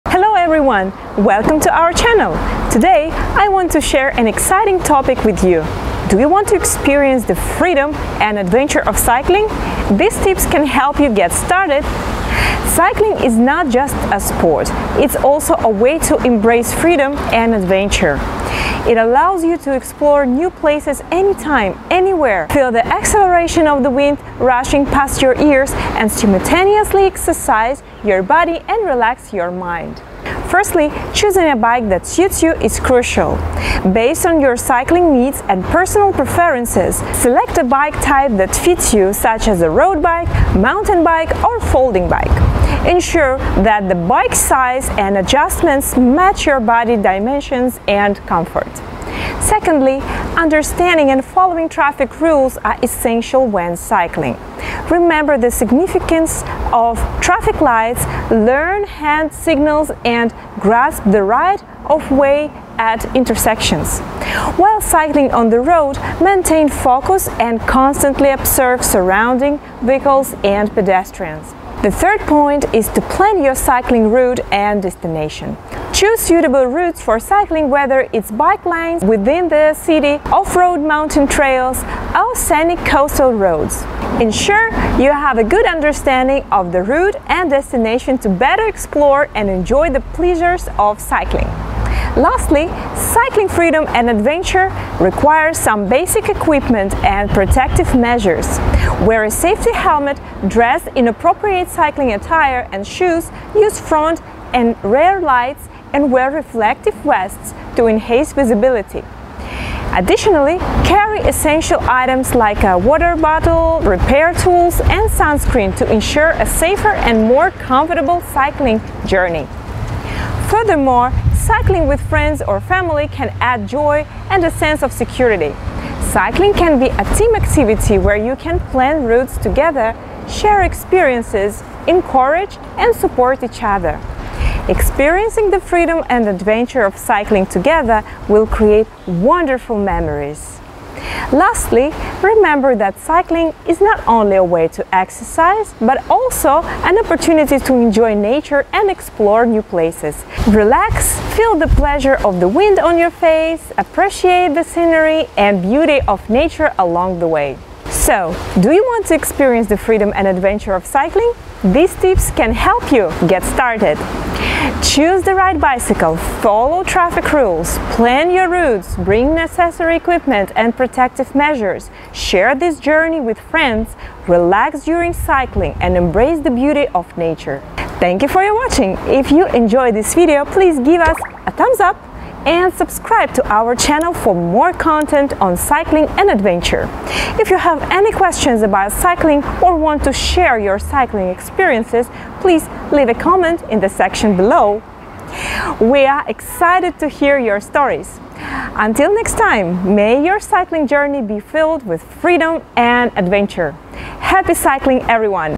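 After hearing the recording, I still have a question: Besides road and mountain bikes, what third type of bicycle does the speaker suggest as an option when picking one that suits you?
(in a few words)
folding bike.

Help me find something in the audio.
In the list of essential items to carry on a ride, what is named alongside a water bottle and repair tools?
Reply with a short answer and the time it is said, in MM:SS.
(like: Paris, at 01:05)
sunscreen, at 01:55.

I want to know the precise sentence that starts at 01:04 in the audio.
While cycling on the road, maintain focus and constantly observe surrounding vehicles and pedestrians.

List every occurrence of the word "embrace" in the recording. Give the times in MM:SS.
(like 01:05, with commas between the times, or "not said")
00:16, 02:55.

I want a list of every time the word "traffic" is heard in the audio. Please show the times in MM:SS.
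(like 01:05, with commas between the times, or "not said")
00:51, 00:57, 02:46.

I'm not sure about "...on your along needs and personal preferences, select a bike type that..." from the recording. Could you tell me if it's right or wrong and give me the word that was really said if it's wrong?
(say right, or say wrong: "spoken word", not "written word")
wrong: "cycling", not "along".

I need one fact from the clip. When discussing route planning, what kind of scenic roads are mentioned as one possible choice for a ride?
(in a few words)
coastal roads.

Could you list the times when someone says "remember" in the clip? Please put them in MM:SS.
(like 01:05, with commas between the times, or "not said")
00:54, 02:22.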